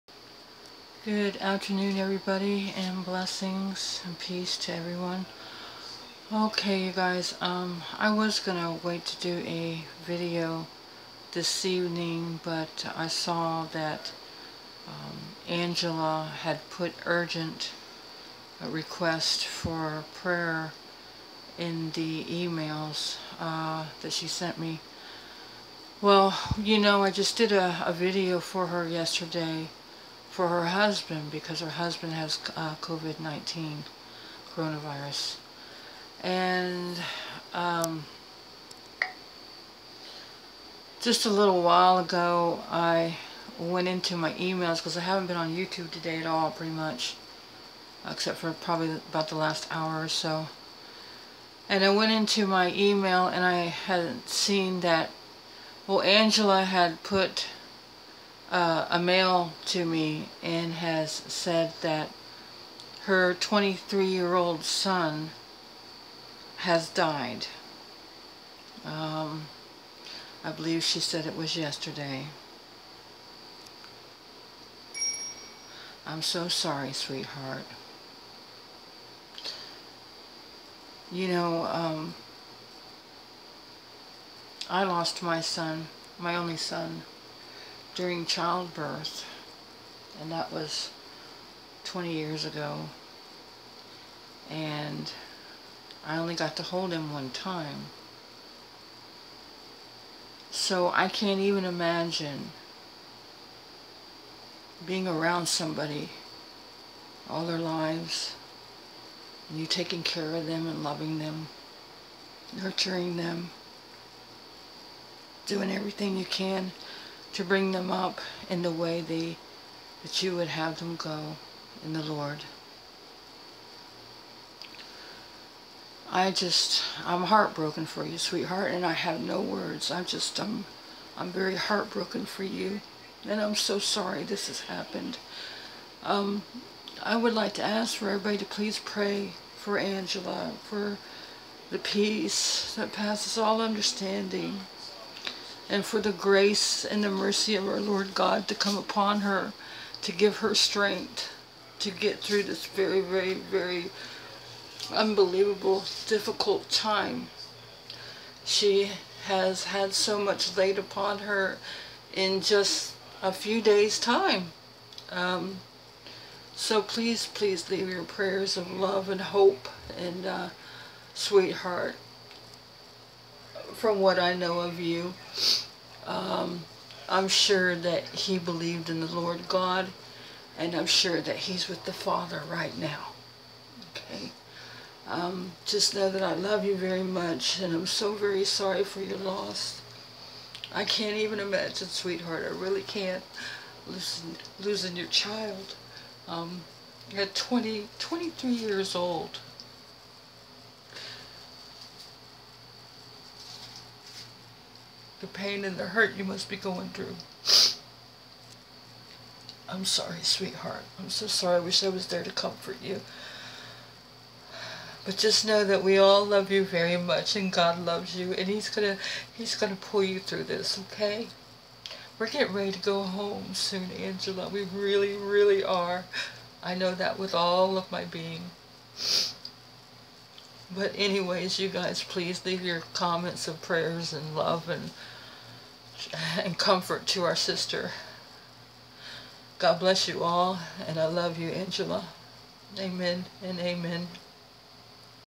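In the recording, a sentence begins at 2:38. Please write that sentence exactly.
She has had so much laid upon her in just a few days' time.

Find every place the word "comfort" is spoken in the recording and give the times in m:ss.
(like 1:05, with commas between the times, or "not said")
3:32, 3:56.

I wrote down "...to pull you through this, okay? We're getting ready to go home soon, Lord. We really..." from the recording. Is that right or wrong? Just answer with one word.
wrong.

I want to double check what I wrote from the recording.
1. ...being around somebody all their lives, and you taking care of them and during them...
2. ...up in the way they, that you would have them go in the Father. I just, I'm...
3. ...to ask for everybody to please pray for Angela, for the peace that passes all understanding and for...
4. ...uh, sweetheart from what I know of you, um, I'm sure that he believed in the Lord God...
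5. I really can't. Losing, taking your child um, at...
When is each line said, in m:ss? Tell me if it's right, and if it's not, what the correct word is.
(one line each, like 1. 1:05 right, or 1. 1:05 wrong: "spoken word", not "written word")
1. 1:44 wrong: "loving", not "during"
2. 1:57 wrong: "Lord", not "Father"
3. 2:17 right
4. 2:50 right
5. 3:12 wrong: "losing", not "taking".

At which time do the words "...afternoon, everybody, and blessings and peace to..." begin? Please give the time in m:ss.
0:01.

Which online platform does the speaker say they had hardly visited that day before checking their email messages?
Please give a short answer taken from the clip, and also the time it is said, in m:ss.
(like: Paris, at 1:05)
YouTube, at 0:45.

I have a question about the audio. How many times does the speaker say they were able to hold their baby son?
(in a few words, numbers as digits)
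1 time.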